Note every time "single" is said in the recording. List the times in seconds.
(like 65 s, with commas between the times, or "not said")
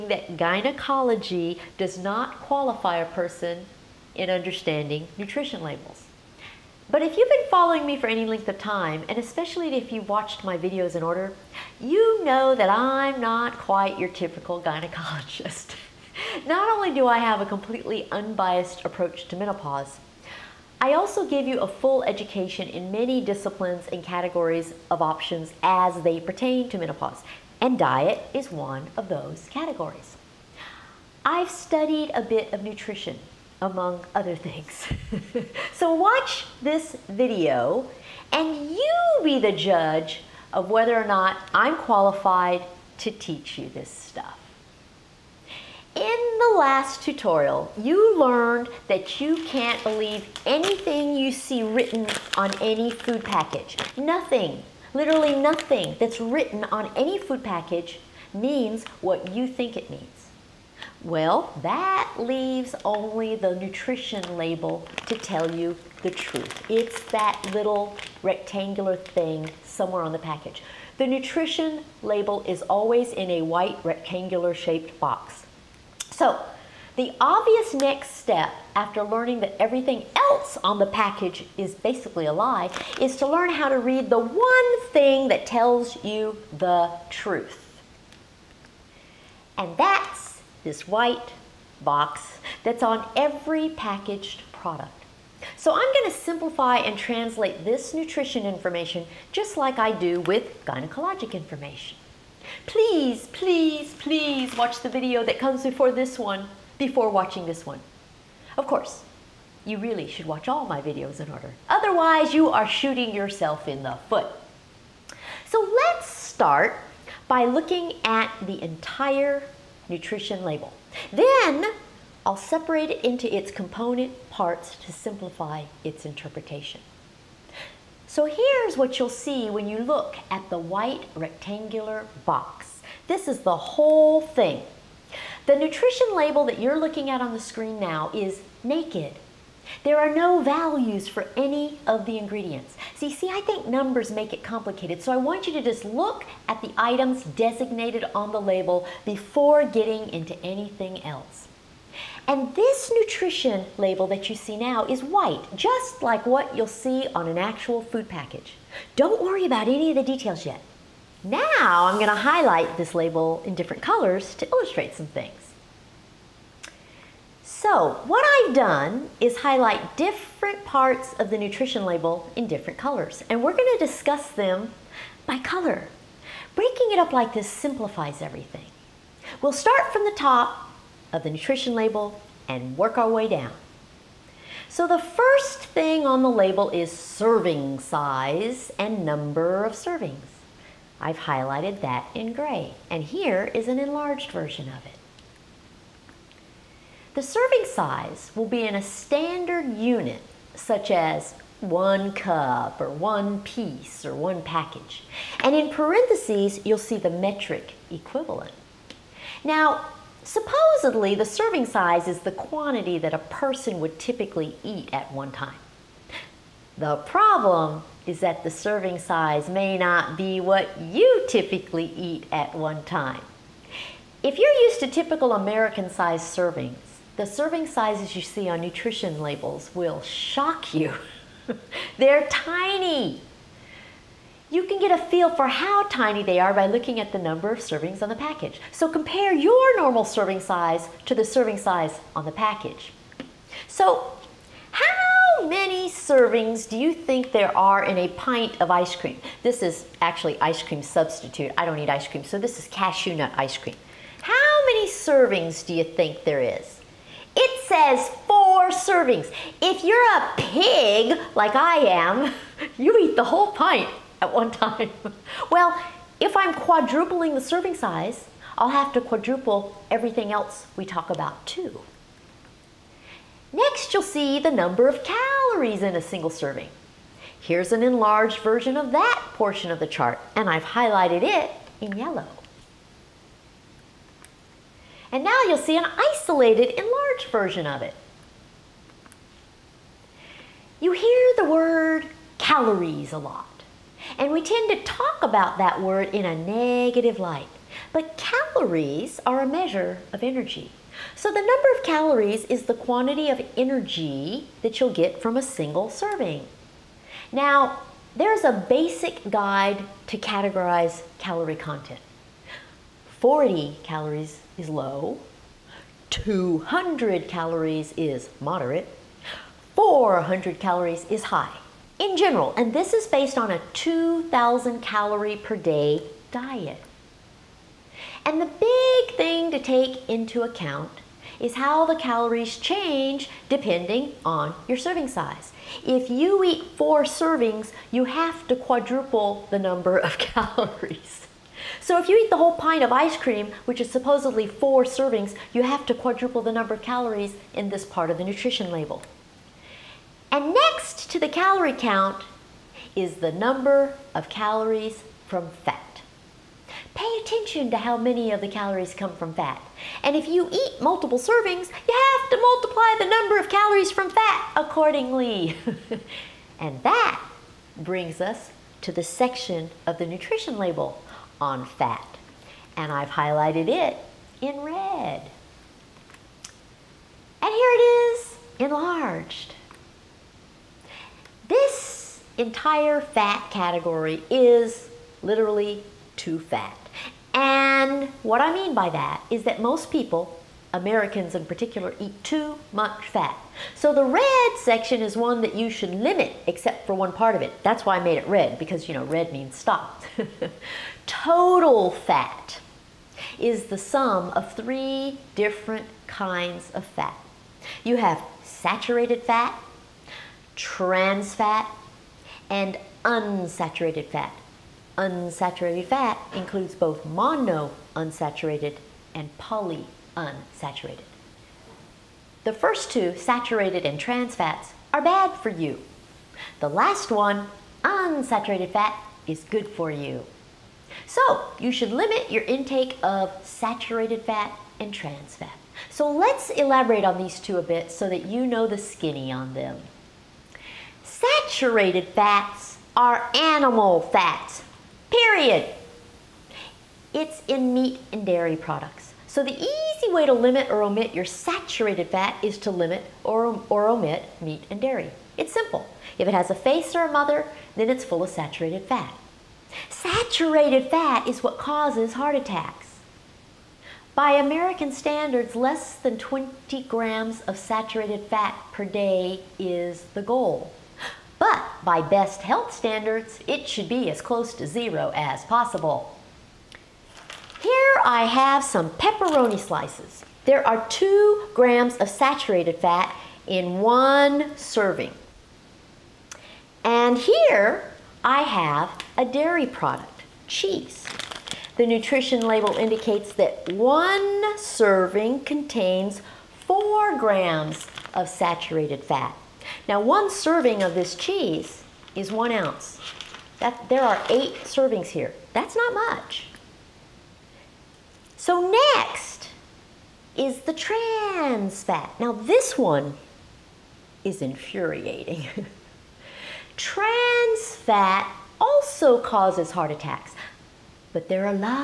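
276 s, 305 s.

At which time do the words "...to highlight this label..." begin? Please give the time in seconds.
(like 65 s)
162 s.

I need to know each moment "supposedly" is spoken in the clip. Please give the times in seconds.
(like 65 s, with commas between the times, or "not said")
210 s, 343 s.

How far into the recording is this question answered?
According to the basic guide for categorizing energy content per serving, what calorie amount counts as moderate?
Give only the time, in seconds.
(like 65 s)
316 s.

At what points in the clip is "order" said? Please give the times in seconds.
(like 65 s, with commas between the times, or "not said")
11 s, 111 s.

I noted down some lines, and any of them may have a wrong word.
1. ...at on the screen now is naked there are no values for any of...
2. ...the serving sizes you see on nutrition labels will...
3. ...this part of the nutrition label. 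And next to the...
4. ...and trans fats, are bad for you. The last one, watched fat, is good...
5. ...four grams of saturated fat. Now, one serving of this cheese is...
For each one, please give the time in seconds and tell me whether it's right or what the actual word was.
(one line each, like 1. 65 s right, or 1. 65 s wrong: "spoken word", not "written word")
1. 137 s right
2. 227 s right
3. 347 s right
4. 423 s wrong: "unsaturated", not "watched"
5. 496 s right.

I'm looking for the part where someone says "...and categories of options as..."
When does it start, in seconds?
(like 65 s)
23 s.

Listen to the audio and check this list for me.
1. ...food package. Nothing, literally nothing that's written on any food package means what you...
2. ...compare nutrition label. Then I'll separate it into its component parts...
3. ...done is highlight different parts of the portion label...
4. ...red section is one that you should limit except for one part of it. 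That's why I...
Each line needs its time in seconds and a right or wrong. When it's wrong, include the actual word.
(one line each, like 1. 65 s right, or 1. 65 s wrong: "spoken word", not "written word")
1. 52 s right
2. 118 s wrong: "entire", not "compare"
3. 168 s wrong: "nutrition", not "portion"
4. 394 s right.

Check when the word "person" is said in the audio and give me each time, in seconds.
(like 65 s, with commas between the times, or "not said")
3 s, 213 s.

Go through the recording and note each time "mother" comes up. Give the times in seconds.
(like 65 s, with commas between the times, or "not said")
457 s.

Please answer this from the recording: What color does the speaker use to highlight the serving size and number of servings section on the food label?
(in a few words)
Gray.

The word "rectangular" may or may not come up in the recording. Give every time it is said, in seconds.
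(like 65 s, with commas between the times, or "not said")
68 s, 73 s, 131 s.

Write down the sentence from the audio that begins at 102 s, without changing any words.
Please, please, please watch the video that comes before this one before watching this one.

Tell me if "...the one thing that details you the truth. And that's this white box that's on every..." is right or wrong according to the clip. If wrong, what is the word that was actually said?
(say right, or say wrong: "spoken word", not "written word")
wrong: "tells", not "details".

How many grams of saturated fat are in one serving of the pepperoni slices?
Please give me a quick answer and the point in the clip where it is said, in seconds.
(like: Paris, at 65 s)
2 grams, at 480 s.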